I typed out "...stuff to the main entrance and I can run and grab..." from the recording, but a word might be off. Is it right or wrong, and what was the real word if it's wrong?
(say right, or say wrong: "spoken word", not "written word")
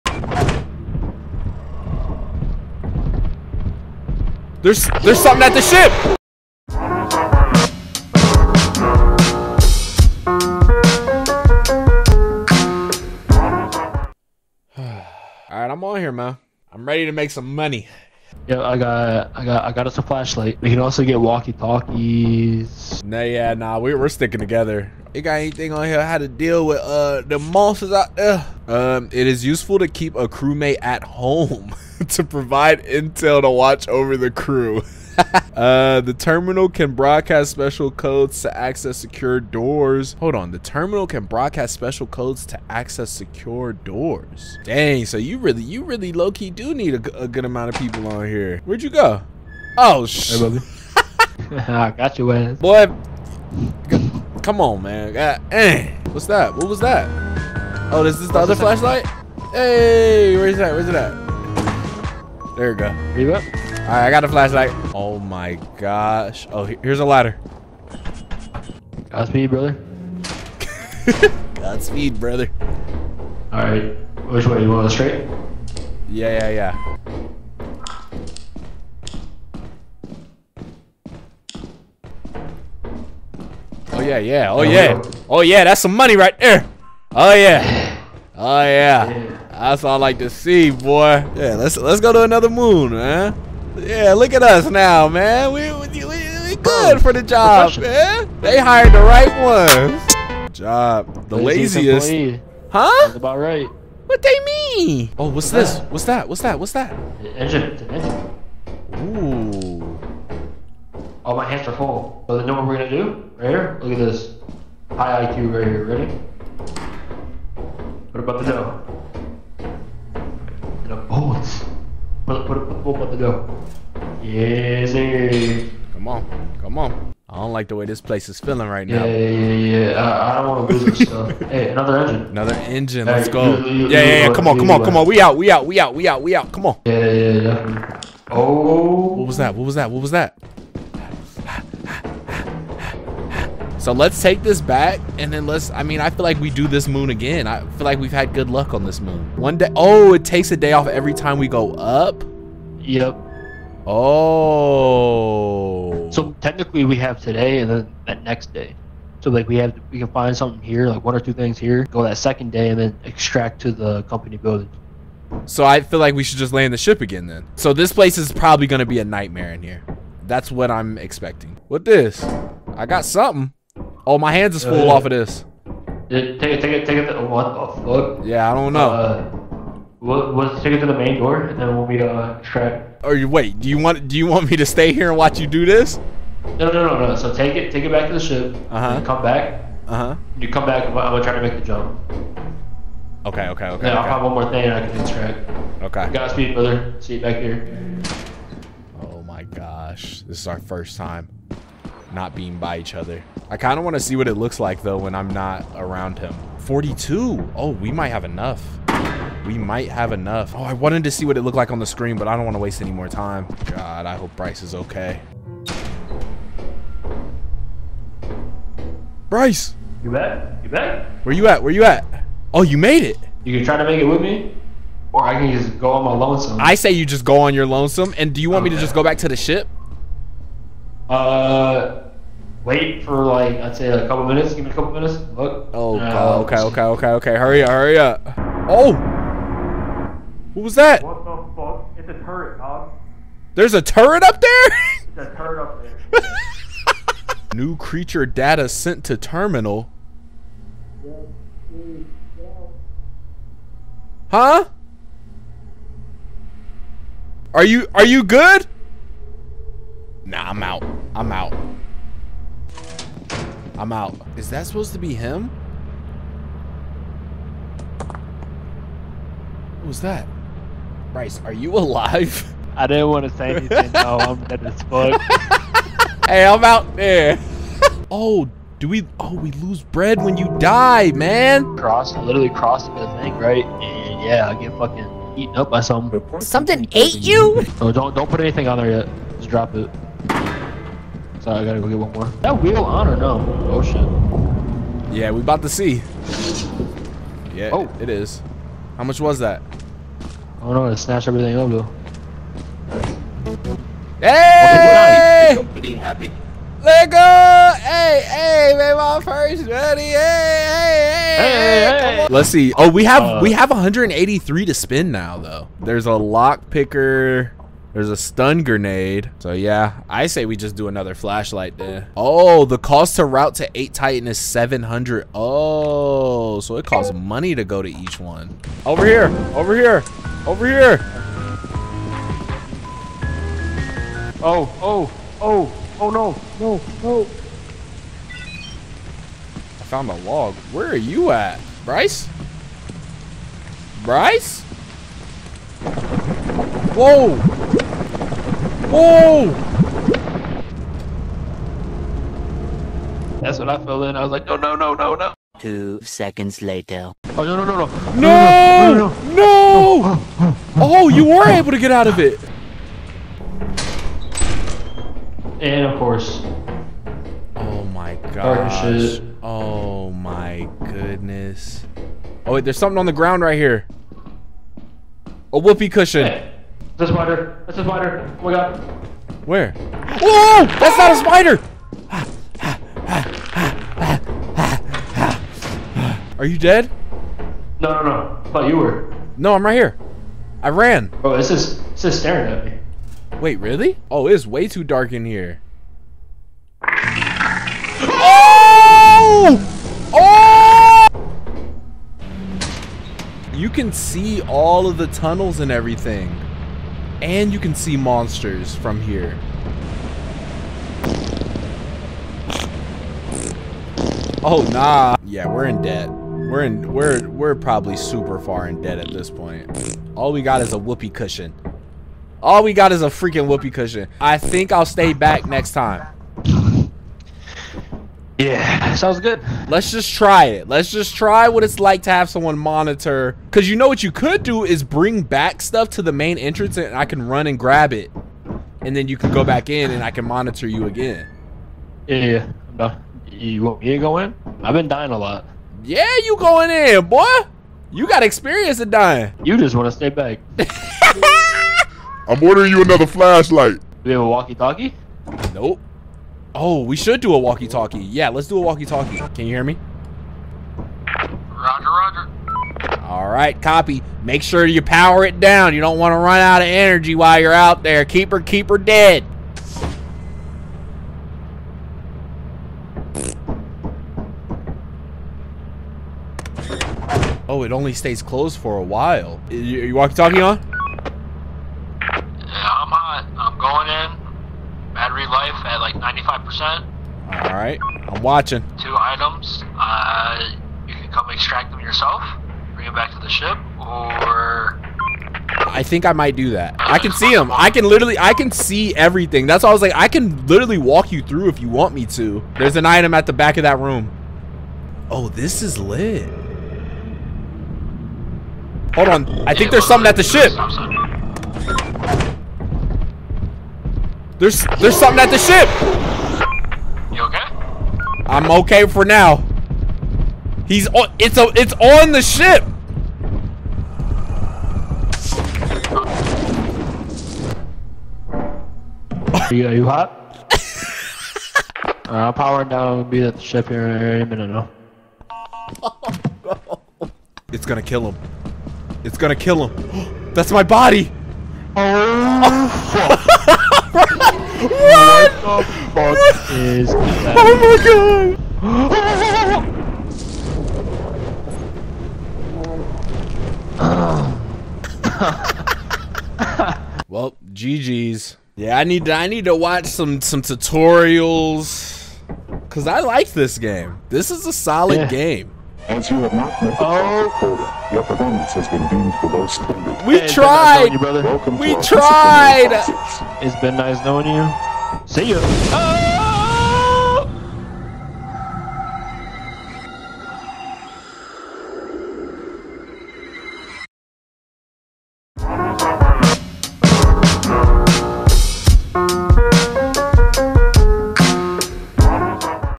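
right.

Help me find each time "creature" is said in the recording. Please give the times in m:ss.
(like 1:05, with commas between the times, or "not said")
4:07.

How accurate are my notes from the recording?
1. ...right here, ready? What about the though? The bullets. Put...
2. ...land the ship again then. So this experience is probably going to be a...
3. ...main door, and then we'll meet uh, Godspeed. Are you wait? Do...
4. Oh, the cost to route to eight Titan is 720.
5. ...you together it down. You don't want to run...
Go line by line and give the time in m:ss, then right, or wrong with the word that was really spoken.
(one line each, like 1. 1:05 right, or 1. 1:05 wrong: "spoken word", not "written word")
1. 1:55 wrong: "dough", not "though"
2. 2:46 wrong: "place", not "experience"
3. 3:00 wrong: "Shrek", not "Godspeed"
4. 5:22 wrong: "700", not "720"
5. 7:44 wrong: "power", not "together".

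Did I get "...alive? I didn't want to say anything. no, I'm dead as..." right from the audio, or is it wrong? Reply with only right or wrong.
right.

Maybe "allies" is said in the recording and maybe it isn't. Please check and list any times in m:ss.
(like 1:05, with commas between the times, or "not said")
not said.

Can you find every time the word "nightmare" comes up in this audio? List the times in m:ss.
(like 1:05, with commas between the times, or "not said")
2:49.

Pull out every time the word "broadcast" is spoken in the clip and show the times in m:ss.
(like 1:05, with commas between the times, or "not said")
0:36, 0:41.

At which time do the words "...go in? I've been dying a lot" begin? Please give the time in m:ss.
7:23.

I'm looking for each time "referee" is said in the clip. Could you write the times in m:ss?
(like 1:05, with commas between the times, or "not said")
not said.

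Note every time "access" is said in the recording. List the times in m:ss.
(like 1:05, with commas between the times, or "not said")
0:38, 0:42.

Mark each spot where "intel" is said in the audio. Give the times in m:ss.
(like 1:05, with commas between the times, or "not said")
0:32.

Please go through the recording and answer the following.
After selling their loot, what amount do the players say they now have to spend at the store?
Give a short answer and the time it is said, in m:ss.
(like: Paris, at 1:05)
183, at 5:13.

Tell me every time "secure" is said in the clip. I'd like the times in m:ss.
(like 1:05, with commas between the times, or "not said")
0:38, 0:43.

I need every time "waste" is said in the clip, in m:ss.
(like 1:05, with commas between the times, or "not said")
3:32.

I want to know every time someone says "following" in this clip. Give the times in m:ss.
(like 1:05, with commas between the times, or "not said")
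not said.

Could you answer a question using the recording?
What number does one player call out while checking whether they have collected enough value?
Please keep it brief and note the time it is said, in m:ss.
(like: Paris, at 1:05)
42, at 3:26.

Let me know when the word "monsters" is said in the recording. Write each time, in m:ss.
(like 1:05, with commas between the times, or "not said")
0:27, 6:47.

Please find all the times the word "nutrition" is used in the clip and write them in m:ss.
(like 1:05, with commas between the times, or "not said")
not said.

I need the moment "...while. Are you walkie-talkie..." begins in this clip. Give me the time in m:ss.
7:58.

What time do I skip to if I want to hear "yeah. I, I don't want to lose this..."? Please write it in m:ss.
2:09.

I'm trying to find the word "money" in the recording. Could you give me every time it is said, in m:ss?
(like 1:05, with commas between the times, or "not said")
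0:17, 1:25, 5:27.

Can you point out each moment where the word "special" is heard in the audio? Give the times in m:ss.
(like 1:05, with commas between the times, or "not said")
0:37, 0:41.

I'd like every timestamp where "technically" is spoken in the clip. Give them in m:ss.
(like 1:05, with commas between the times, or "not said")
2:36.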